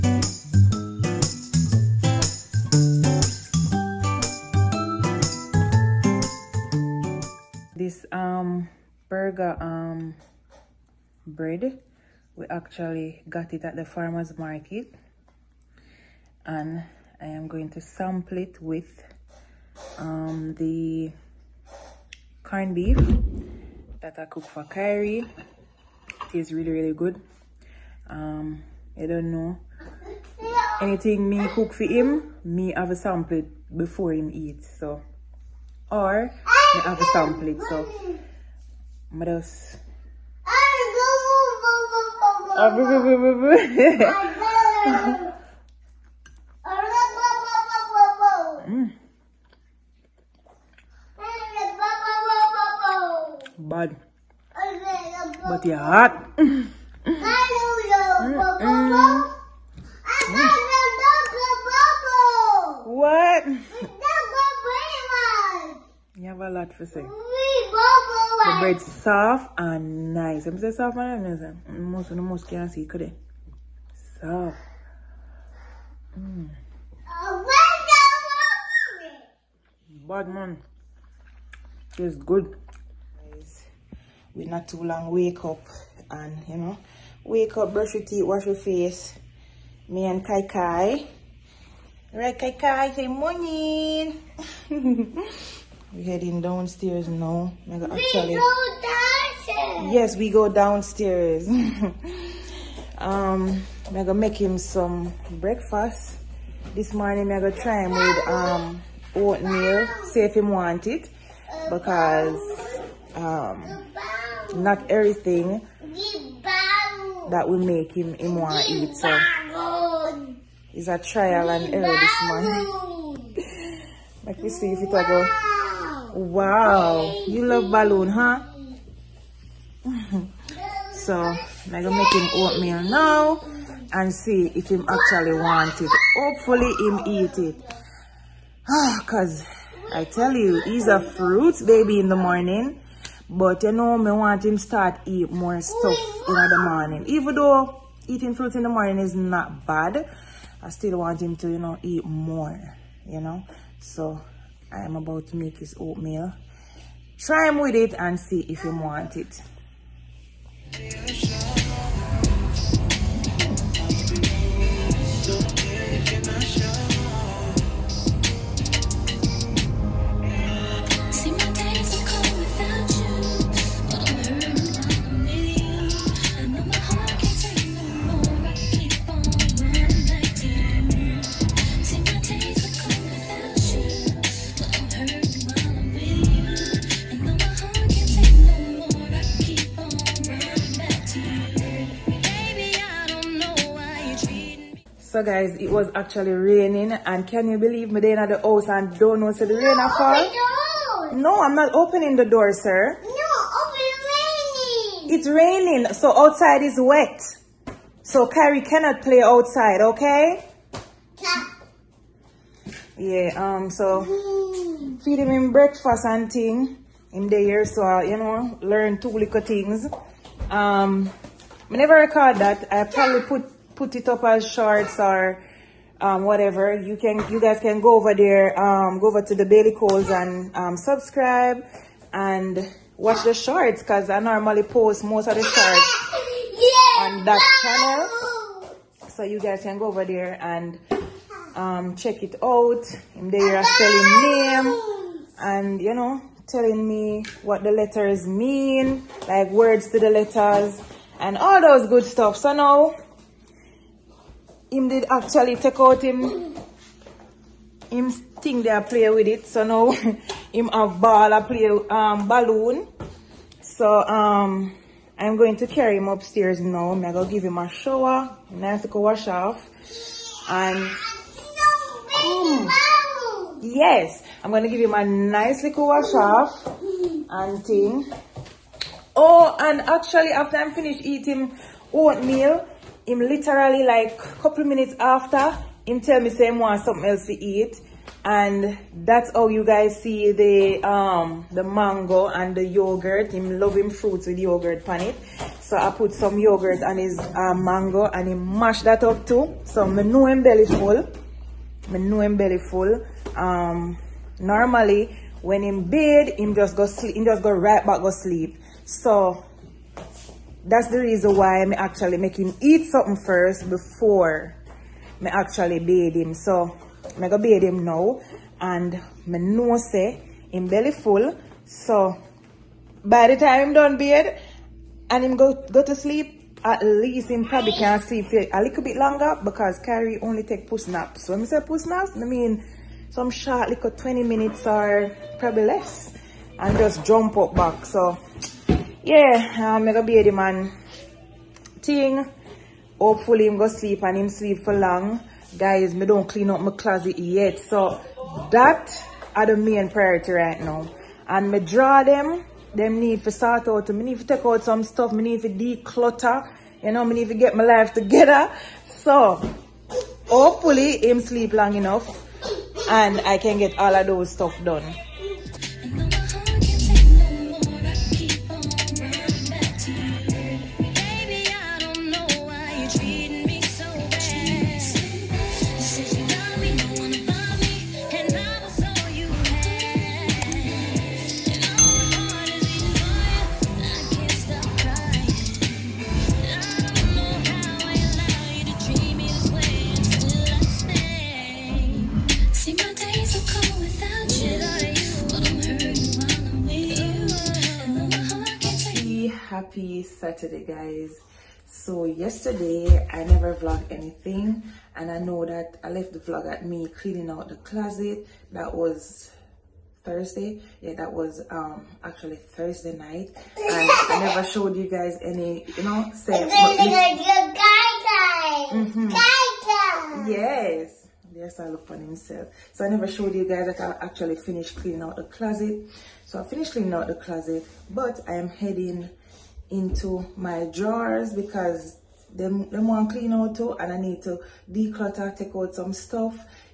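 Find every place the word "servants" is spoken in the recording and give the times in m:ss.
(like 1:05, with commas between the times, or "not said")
not said.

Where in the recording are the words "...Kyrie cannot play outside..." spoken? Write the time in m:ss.
3:28.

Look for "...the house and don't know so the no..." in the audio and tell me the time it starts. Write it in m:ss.
3:18.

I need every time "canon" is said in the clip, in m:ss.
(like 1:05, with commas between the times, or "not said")
not said.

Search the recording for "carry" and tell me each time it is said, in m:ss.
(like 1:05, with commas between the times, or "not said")
4:25.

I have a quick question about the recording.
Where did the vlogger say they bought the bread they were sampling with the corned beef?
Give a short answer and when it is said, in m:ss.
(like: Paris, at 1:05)
Farmers market, at 0:13.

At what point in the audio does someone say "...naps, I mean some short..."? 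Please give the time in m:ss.
5:31.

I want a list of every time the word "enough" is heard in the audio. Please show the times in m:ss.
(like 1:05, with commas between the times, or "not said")
6:01.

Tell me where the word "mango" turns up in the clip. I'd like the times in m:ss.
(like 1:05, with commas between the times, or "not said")
4:51, 4:57.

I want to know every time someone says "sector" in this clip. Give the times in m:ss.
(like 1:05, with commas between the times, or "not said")
not said.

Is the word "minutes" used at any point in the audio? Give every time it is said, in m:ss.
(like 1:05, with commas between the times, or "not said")
4:44, 5:34.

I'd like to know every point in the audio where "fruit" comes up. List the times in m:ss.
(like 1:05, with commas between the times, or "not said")
2:20, 2:28, 4:53.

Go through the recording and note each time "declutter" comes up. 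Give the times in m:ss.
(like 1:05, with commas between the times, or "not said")
5:55, 7:14.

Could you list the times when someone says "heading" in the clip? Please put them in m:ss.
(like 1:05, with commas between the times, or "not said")
1:36, 7:08.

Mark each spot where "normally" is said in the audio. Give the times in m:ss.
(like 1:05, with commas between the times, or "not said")
3:54, 5:04.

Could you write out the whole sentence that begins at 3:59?
So you guys can go over there and um, check it out.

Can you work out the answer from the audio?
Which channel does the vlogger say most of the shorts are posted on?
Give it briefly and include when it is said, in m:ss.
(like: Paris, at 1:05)
Bailey Coles, at 3:49.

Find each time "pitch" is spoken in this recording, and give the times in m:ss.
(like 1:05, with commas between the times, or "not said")
not said.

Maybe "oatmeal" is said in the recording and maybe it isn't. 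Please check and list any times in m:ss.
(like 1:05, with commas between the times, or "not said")
1:49, 2:12, 2:35, 4:41.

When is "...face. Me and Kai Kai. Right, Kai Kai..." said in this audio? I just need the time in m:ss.
1:28.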